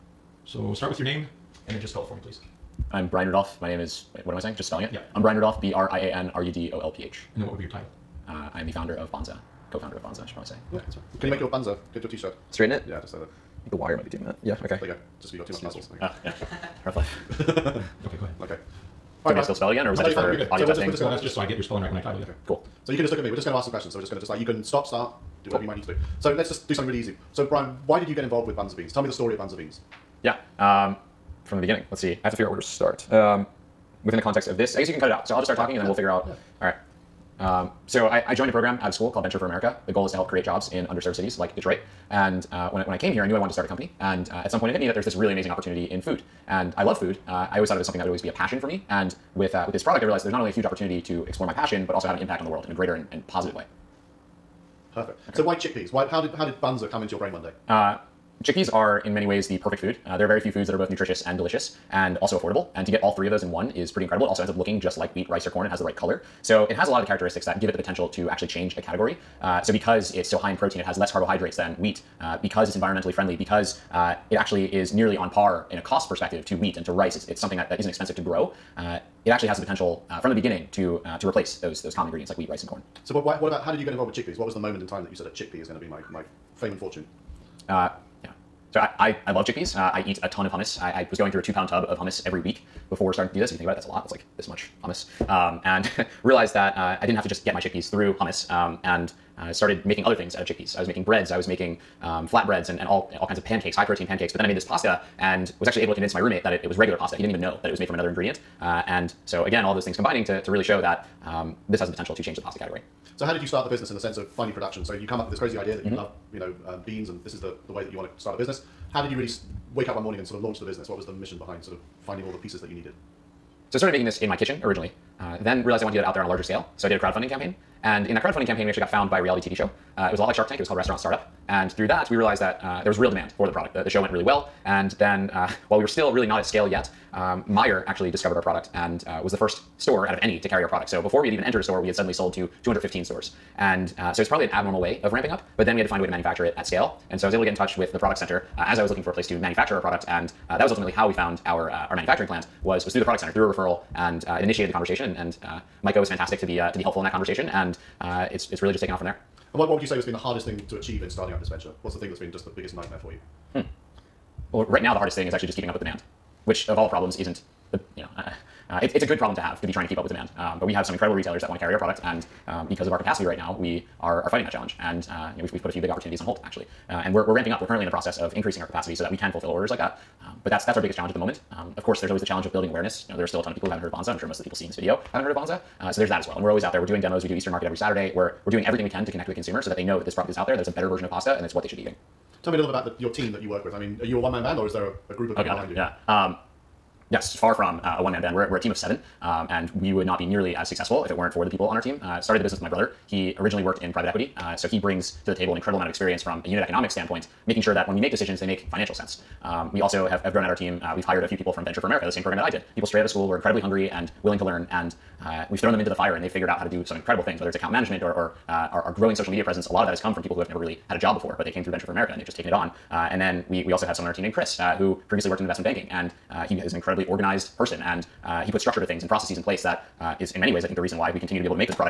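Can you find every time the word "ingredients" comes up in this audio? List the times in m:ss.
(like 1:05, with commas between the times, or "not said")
1:22, 1:48.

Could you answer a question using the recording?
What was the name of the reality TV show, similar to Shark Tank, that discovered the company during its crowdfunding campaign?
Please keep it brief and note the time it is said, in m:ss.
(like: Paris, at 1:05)
Restaurant Startup, at 2:10.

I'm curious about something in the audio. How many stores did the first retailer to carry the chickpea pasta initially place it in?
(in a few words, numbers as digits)
215.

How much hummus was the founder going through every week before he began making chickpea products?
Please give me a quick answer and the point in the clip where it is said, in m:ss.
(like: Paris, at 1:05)
two pound tub, at 1:31.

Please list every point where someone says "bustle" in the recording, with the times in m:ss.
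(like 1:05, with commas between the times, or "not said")
not said.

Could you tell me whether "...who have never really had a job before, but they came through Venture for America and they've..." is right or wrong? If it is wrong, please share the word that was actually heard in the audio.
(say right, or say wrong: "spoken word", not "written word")
right.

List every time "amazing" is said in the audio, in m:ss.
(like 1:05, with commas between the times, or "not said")
0:45.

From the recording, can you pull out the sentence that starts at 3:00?
Um, but that's, that's our biggest challenge at the moment.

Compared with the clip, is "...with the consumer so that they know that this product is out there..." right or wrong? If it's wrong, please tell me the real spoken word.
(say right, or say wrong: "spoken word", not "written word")
right.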